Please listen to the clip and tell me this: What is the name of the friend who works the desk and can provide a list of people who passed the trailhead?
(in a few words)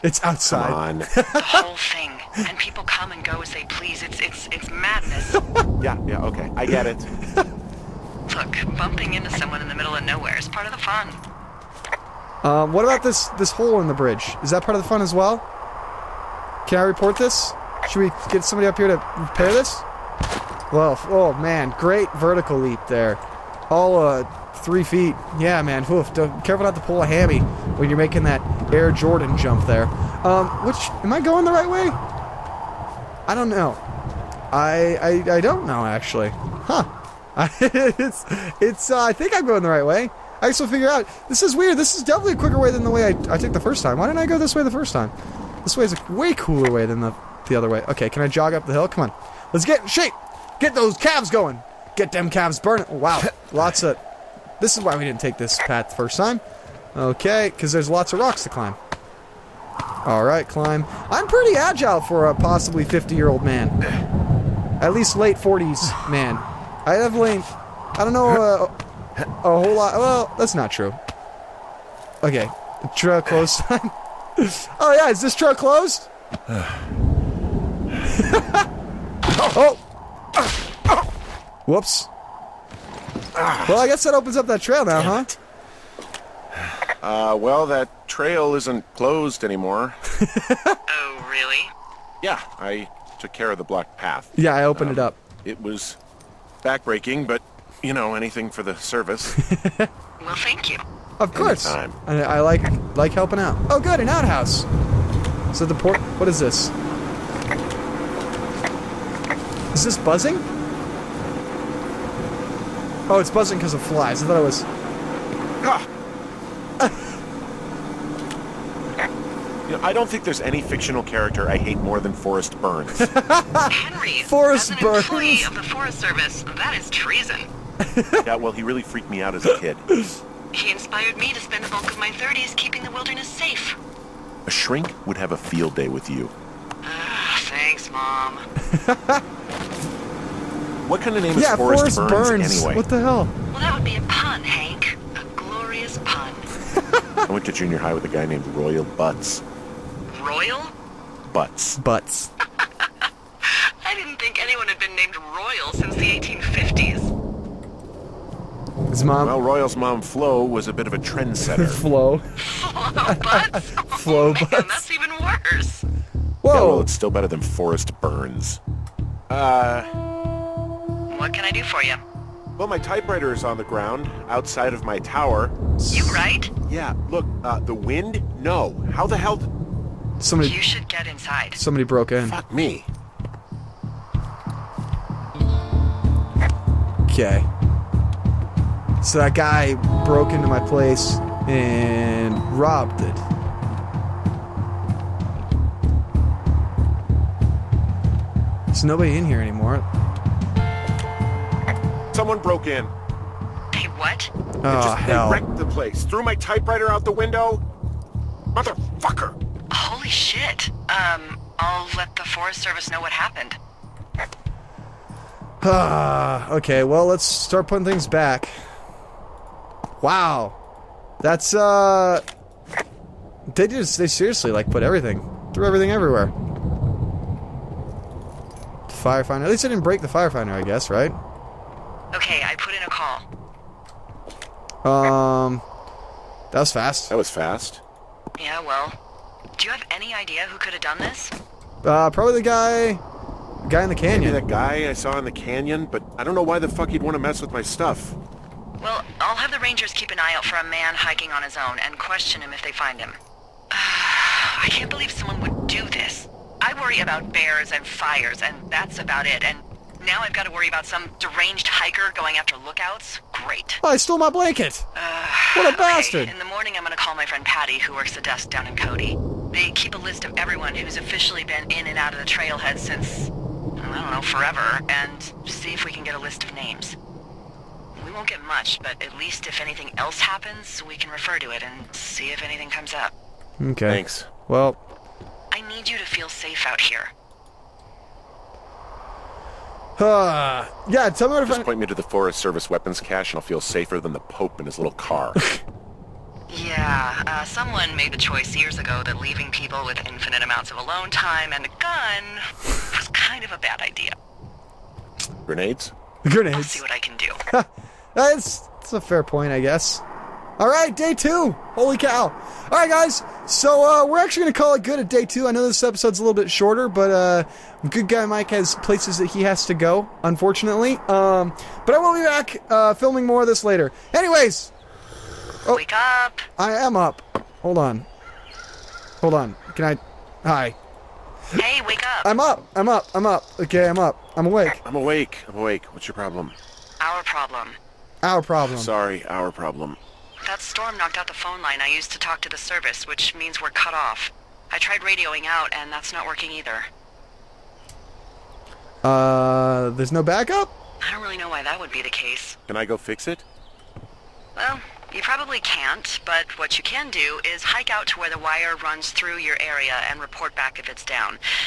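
Patty.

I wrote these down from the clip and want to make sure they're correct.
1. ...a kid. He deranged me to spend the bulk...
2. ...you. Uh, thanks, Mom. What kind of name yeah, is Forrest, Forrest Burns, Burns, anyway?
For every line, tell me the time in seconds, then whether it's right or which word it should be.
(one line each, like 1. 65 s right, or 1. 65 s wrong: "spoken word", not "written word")
1. 129 s wrong: "inspired", not "deranged"
2. 136 s right.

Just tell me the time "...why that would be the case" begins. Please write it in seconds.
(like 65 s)
351 s.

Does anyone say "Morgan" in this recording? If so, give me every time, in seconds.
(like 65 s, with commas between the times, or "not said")
not said.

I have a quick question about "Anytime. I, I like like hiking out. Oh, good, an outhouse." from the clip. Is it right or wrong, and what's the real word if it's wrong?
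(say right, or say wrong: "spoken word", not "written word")
wrong: "helping", not "hiking".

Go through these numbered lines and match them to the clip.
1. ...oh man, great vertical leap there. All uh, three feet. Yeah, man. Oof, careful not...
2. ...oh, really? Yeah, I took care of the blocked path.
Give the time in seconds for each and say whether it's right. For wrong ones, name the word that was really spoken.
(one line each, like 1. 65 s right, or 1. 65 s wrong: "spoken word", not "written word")
1. 21 s right
2. 90 s right.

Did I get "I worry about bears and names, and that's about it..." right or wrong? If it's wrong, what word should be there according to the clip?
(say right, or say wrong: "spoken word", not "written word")
wrong: "fires", not "names".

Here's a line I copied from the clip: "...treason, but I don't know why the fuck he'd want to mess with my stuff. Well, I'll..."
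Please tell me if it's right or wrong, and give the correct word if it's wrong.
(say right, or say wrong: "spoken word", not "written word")
wrong: "canyon", not "treason".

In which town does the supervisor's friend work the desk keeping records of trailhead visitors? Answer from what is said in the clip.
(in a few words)
Cody.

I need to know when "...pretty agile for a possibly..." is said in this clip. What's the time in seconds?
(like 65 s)
61 s.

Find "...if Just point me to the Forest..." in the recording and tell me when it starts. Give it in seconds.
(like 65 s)
291 s.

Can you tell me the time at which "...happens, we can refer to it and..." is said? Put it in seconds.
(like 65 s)
280 s.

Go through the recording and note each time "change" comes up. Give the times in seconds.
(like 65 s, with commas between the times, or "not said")
not said.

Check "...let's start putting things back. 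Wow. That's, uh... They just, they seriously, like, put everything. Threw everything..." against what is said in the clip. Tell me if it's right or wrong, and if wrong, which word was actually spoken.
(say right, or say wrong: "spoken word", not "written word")
right.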